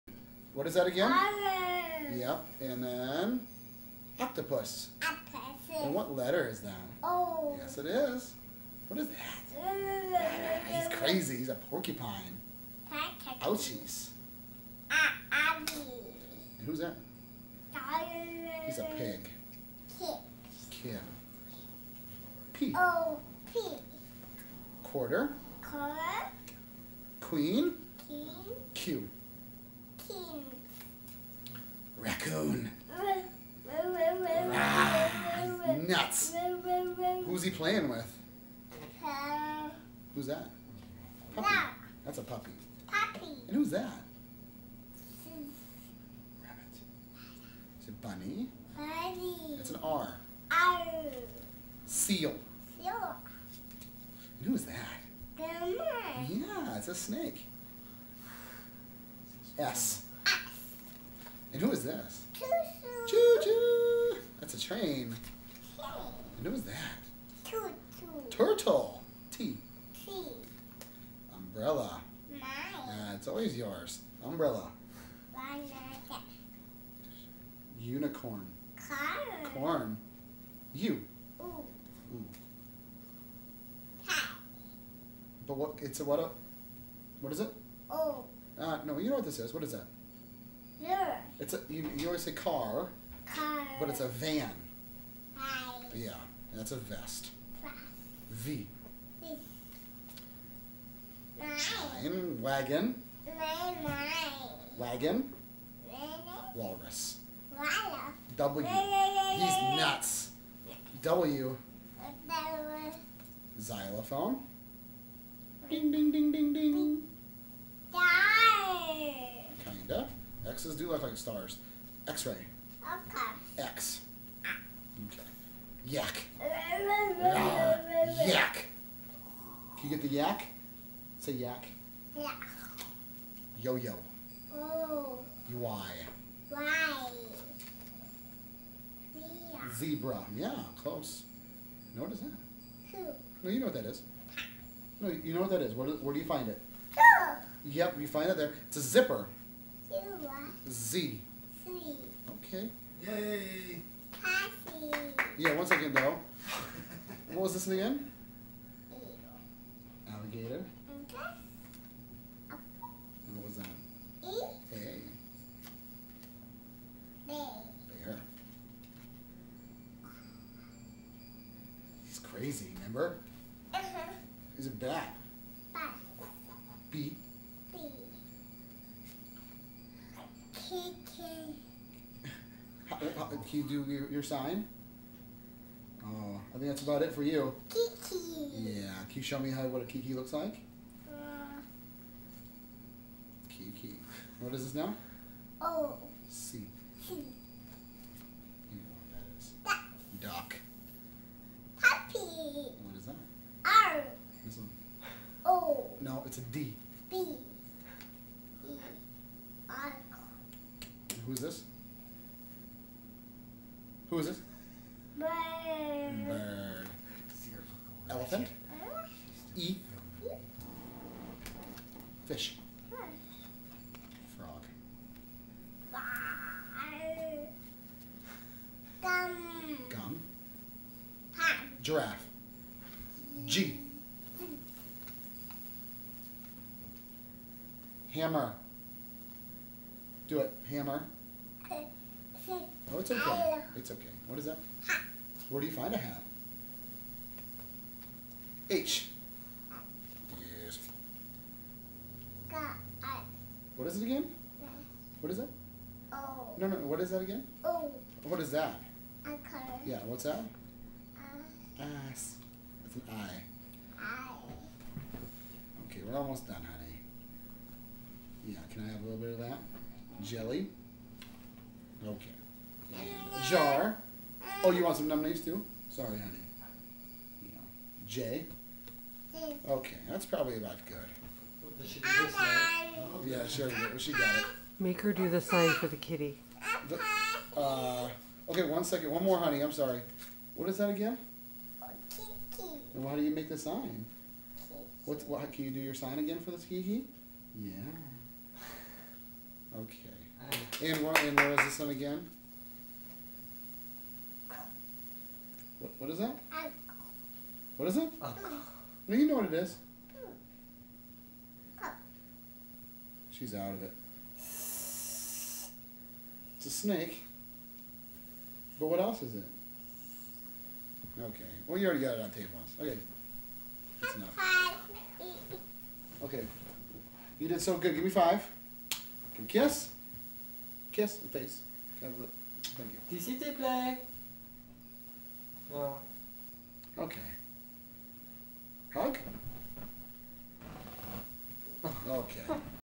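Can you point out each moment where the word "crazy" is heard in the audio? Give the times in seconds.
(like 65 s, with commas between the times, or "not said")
10 s, 172 s.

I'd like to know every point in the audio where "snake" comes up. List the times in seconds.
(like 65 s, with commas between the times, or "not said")
56 s, 316 s.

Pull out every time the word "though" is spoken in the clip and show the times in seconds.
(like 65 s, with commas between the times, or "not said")
155 s.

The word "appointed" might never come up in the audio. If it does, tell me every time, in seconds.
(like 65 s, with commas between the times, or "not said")
not said.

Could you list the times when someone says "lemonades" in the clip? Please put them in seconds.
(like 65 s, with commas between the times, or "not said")
275 s.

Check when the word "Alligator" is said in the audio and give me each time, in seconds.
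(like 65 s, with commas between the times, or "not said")
160 s.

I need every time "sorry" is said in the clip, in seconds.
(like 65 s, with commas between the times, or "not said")
275 s, 289 s.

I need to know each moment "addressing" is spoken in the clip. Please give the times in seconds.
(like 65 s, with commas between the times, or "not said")
not said.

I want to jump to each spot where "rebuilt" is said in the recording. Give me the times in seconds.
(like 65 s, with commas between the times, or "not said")
not said.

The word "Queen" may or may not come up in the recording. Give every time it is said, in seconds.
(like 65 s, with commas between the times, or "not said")
27 s.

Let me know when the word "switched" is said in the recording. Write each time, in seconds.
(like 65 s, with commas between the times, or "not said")
not said.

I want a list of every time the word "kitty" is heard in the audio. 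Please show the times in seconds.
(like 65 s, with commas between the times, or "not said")
285 s.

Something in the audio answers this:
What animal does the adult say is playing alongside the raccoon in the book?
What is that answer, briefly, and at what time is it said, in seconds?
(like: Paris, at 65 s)
A puppy, at 42 s.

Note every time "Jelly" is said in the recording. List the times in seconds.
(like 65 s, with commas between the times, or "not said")
270 s.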